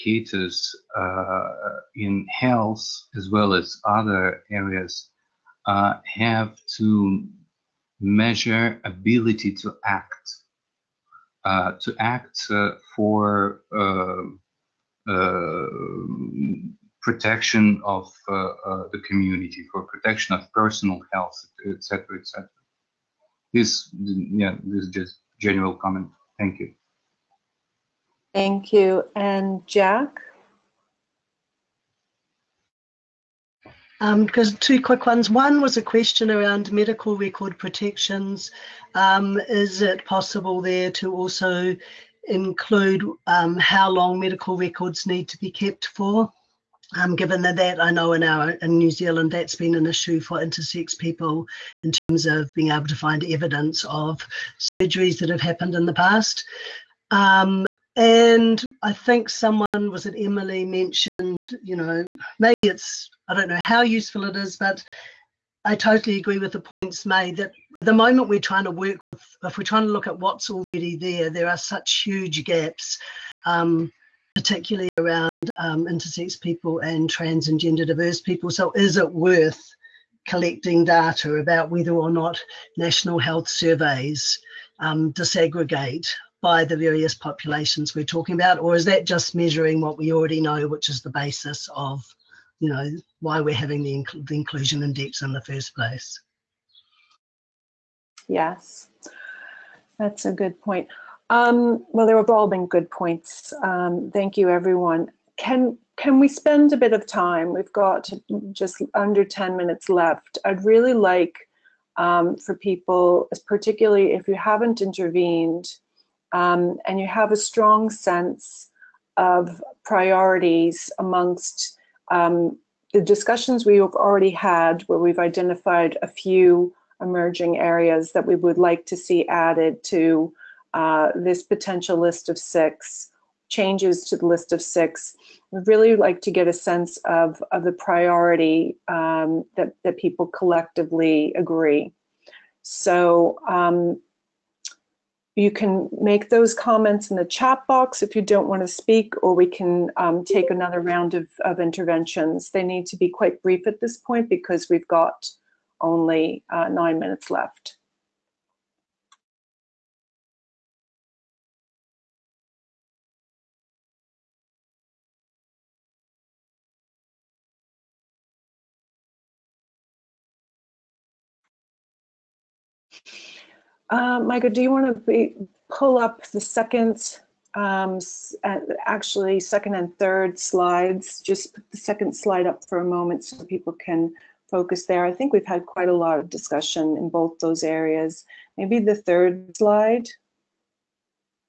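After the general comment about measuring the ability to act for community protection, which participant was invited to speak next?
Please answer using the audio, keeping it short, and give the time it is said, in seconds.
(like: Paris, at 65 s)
Jack, at 29 s.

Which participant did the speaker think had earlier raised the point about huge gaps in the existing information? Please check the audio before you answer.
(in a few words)
Emily.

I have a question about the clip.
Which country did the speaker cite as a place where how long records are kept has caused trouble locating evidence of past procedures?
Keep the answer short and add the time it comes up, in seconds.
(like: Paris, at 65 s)
New Zealand, at 48 s.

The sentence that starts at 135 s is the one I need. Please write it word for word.
We really like to get a sense of, of the priority um, that, that people collectively agree.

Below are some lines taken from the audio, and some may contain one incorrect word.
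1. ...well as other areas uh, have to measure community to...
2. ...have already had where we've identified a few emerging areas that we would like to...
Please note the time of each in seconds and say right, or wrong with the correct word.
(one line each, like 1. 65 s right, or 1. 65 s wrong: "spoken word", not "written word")
1. 3 s wrong: "ability", not "community"
2. 123 s right.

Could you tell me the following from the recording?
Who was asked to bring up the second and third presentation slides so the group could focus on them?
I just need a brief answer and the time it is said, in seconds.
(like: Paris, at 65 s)
Michael, at 174 s.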